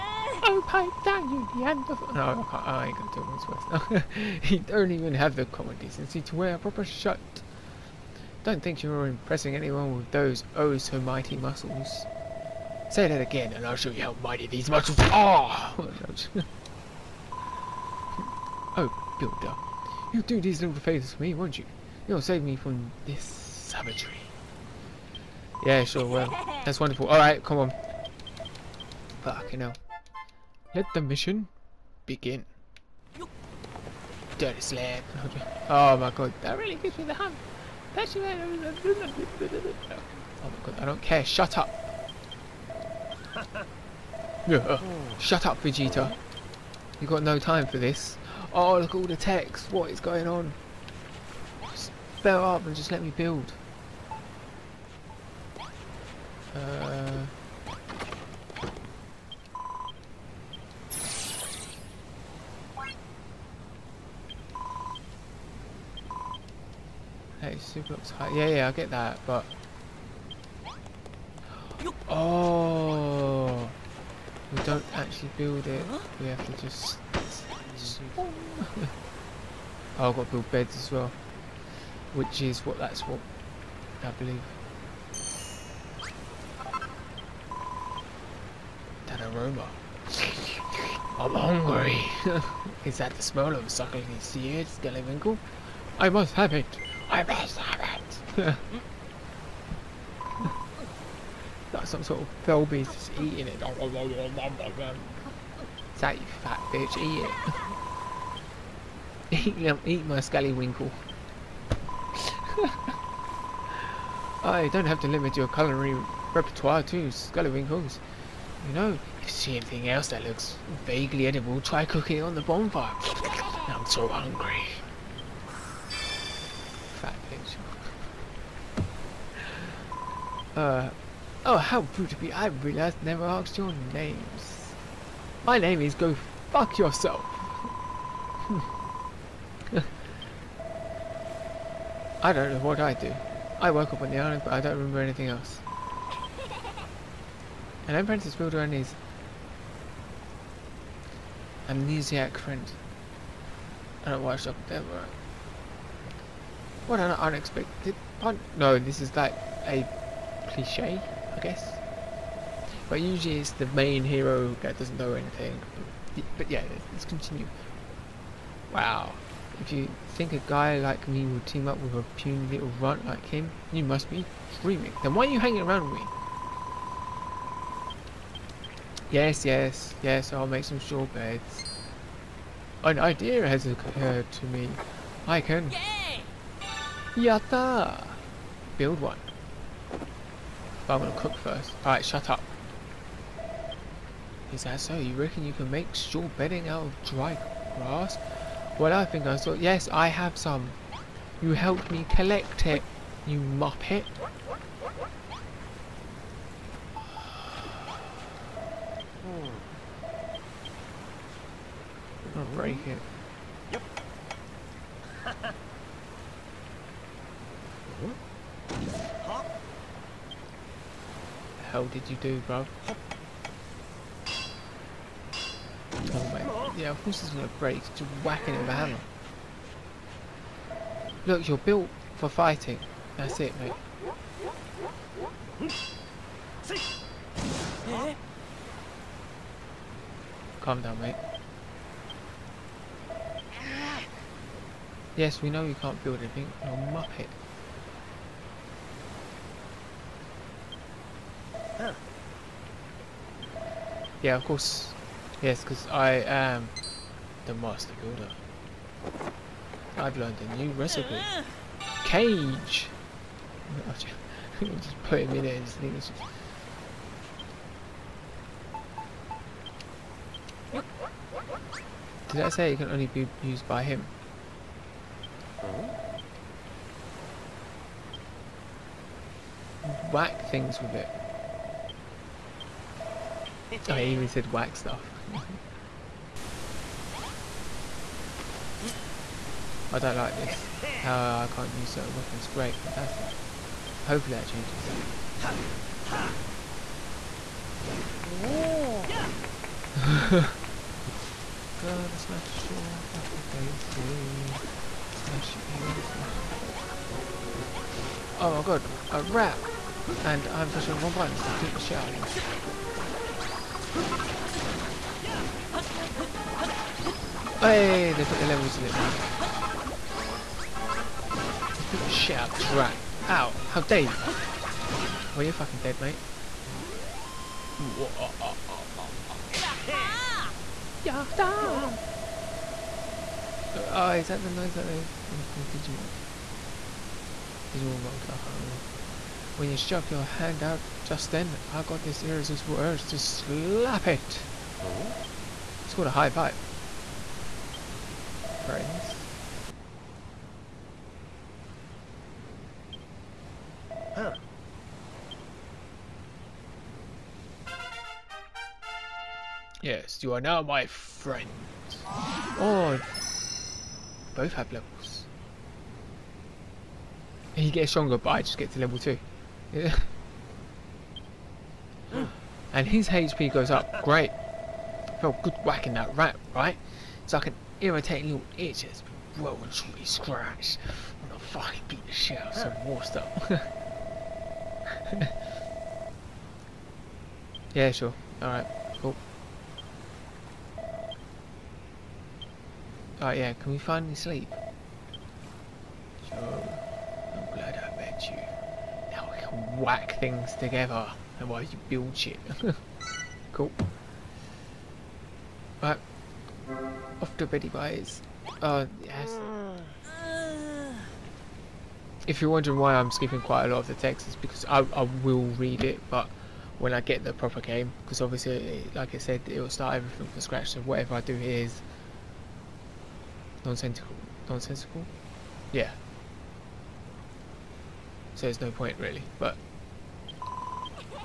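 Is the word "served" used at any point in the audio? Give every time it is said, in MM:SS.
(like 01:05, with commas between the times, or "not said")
not said.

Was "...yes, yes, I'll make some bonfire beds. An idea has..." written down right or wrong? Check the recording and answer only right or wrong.
wrong.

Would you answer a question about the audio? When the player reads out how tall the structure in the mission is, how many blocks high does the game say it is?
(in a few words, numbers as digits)
82.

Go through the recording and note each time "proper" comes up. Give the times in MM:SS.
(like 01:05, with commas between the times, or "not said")
00:06, 06:57.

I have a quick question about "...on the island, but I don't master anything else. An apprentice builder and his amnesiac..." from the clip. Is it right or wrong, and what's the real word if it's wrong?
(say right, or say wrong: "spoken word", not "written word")
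wrong: "remember", not "master".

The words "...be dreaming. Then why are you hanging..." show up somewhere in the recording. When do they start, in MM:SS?
02:54.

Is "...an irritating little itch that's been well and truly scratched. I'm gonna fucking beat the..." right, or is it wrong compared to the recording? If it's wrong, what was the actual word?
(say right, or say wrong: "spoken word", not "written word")
right.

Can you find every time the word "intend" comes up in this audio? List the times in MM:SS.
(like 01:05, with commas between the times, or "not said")
not said.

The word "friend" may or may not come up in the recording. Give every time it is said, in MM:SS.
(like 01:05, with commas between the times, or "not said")
02:32, 05:48, 06:00.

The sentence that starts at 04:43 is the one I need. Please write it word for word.
I oh, even said whack stuff.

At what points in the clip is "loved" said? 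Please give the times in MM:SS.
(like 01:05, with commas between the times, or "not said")
not said.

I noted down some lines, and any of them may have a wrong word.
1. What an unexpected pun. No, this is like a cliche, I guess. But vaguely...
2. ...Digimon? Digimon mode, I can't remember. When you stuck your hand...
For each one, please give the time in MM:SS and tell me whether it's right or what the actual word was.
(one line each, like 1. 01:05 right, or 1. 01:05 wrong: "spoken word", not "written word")
1. 02:36 wrong: "usually", not "vaguely"
2. 05:35 right.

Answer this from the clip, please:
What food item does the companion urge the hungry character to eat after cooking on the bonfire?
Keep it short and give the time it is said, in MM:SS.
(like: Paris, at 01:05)
scallywinkle, at 01:50.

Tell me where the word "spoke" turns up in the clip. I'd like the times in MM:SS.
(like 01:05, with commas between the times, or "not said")
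not said.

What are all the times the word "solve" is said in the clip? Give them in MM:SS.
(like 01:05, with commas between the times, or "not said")
not said.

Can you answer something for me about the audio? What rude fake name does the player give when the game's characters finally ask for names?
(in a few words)
Go Fuck Yourself.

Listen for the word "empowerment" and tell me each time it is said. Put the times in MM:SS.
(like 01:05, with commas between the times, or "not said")
not said.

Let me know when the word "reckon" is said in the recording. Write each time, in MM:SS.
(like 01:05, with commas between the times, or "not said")
03:15.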